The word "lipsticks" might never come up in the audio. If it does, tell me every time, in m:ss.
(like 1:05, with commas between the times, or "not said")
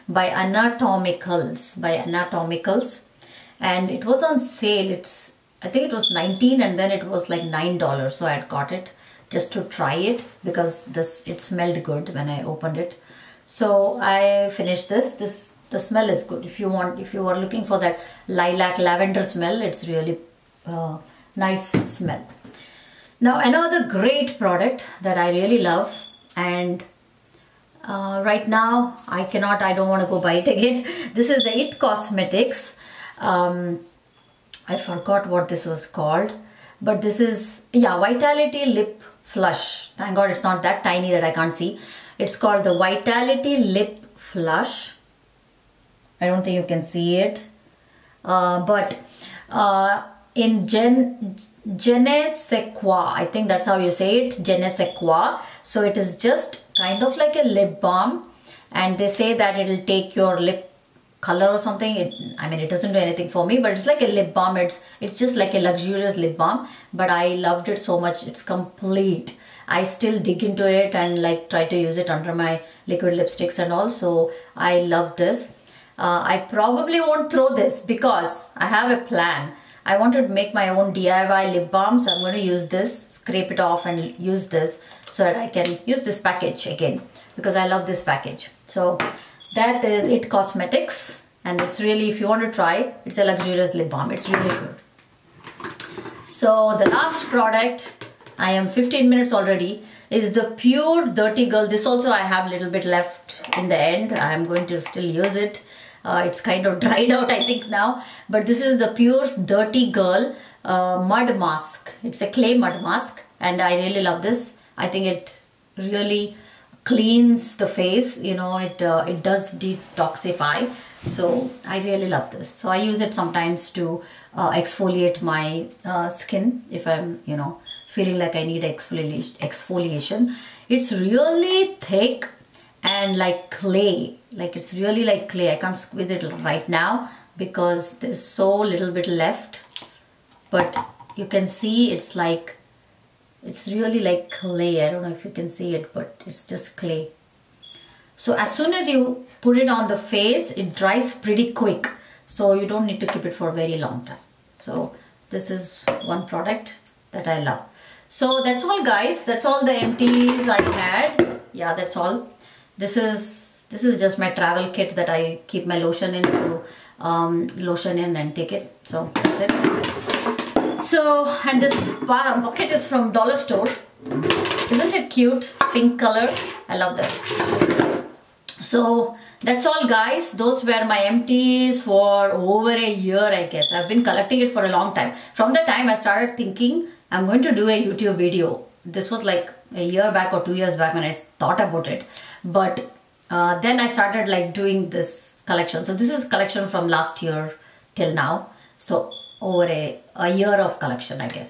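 1:13.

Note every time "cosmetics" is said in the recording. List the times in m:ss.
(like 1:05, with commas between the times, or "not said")
0:31, 1:30.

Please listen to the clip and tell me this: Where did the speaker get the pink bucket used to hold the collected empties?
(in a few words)
Dollar Store.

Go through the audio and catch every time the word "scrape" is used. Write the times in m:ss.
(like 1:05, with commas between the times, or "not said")
1:23.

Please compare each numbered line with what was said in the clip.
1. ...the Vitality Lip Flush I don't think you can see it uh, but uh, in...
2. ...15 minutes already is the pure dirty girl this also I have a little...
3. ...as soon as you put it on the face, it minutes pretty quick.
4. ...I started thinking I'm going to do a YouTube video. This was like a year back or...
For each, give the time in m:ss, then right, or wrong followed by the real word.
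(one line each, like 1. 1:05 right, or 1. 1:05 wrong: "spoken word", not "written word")
1. 0:42 right
2. 1:38 right
3. 2:28 wrong: "dries", not "minutes"
4. 3:05 right.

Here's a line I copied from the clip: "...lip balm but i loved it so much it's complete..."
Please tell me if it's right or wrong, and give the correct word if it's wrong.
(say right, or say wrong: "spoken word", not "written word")
right.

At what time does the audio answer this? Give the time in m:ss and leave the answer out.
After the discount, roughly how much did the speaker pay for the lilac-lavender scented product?
0:07.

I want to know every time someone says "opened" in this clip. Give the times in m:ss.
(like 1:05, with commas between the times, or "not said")
0:12.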